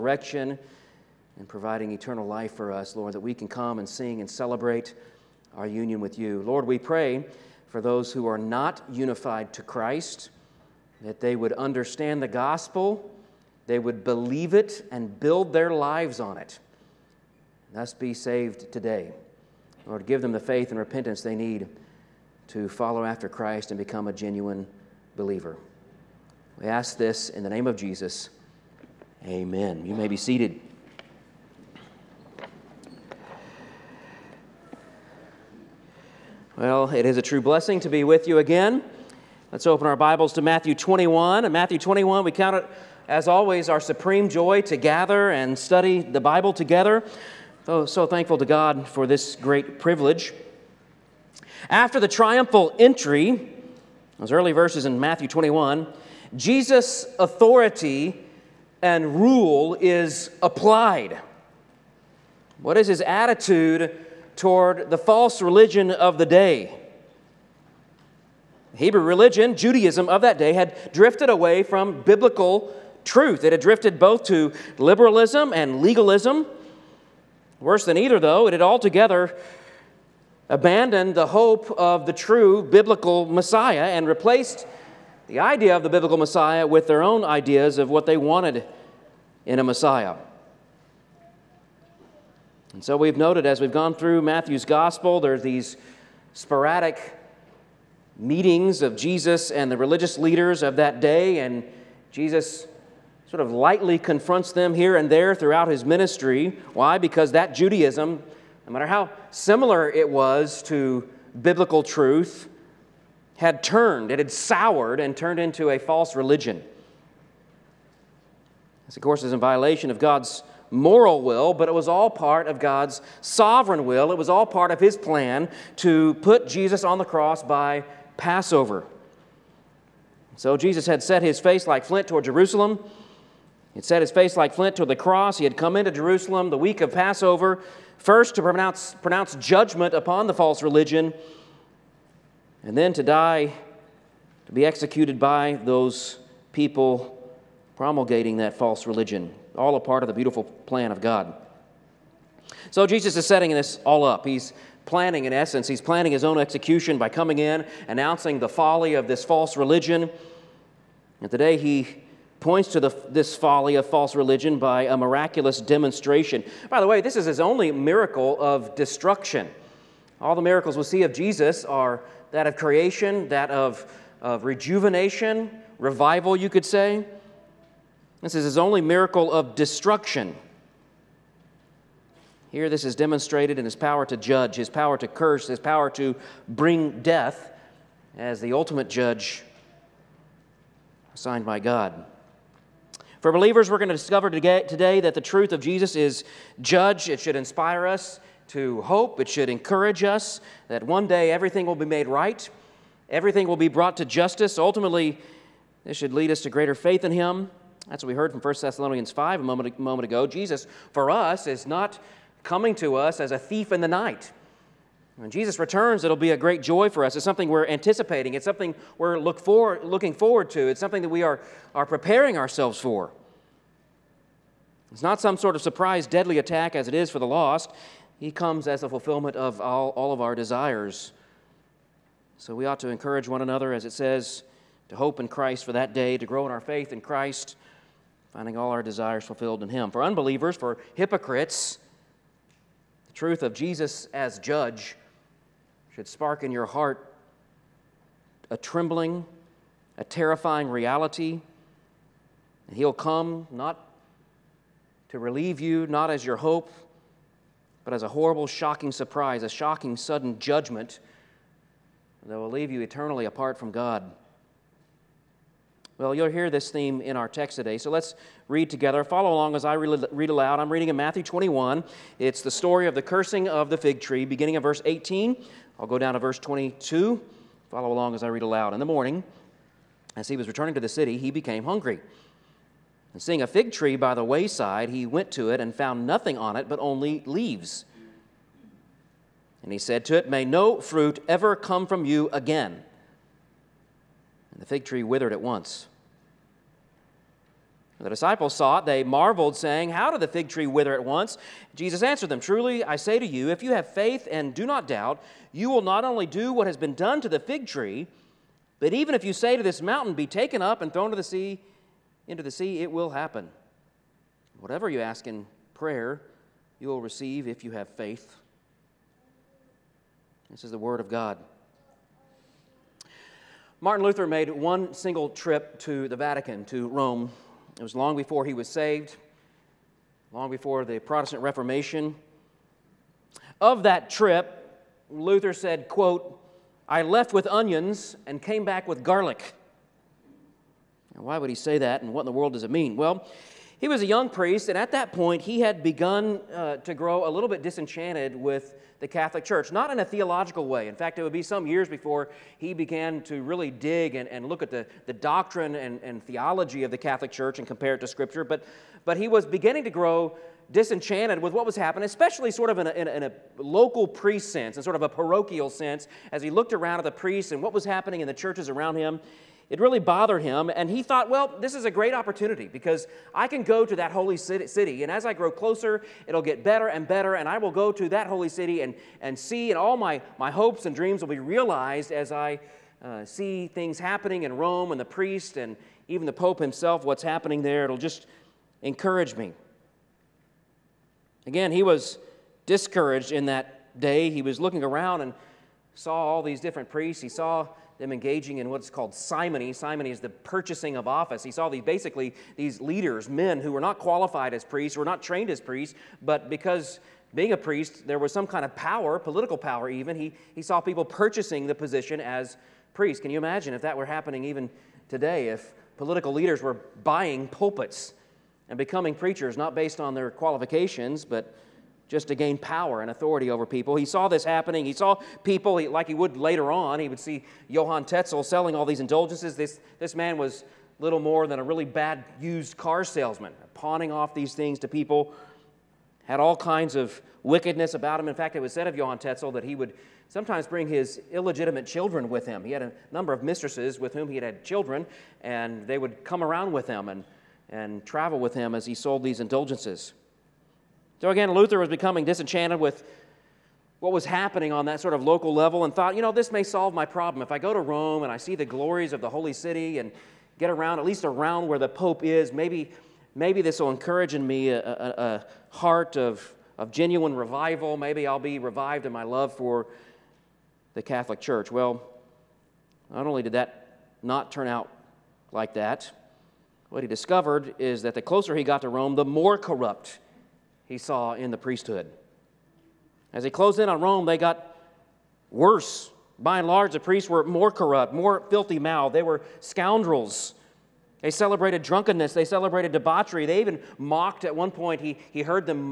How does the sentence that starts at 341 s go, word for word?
Now, why would he say that, and what in the world does it mean?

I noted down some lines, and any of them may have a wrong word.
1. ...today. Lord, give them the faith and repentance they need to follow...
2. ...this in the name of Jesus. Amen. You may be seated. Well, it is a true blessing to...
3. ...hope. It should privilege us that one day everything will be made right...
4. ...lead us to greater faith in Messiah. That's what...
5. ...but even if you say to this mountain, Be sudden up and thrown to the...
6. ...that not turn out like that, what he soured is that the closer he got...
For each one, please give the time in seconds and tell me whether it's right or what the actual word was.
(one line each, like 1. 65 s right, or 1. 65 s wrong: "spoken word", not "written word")
1. 18 s right
2. 26 s right
3. 198 s wrong: "encourage", not "privilege"
4. 206 s wrong: "Him", not "Messiah"
5. 308 s wrong: "taken", not "sudden"
6. 473 s wrong: "discovered", not "soured".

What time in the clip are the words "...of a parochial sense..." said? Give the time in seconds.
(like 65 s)
364 s.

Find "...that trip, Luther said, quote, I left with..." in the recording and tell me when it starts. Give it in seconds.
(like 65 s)
333 s.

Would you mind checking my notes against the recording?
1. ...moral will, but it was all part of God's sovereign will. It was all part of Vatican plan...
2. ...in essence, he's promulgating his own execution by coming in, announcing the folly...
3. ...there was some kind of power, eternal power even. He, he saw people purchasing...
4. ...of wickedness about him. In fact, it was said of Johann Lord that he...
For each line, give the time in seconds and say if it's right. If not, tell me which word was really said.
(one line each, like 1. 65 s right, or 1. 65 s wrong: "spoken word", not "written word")
1. 120 s wrong: "His", not "Vatican"
2. 155 s wrong: "planning", not "promulgating"
3. 408 s wrong: "political", not "eternal"
4. 436 s wrong: "Tetzel", not "Lord".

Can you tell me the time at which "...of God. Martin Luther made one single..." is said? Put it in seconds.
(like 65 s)
321 s.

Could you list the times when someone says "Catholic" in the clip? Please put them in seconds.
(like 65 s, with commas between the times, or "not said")
349 s, 356 s, 471 s.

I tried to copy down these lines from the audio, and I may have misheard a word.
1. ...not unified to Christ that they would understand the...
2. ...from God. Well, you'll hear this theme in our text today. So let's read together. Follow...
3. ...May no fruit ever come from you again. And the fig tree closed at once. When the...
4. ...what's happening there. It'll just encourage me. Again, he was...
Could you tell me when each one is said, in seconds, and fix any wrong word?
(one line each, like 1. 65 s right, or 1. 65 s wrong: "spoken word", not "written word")
1. 8 s right
2. 263 s right
3. 290 s wrong: "withered", not "closed"
4. 387 s right.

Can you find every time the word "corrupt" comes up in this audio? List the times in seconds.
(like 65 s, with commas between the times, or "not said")
479 s, 487 s.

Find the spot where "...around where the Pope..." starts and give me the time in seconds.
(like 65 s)
461 s.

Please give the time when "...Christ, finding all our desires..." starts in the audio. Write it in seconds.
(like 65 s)
237 s.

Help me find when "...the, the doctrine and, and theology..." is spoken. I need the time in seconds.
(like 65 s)
354 s.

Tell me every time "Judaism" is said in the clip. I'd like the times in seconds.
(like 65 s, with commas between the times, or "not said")
69 s, 107 s.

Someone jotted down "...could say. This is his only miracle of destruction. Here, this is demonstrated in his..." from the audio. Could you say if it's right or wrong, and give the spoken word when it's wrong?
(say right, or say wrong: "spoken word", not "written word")
right.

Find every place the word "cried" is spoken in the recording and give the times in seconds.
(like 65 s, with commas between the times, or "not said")
not said.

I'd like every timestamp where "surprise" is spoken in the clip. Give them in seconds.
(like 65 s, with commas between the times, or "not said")
225 s, 258 s.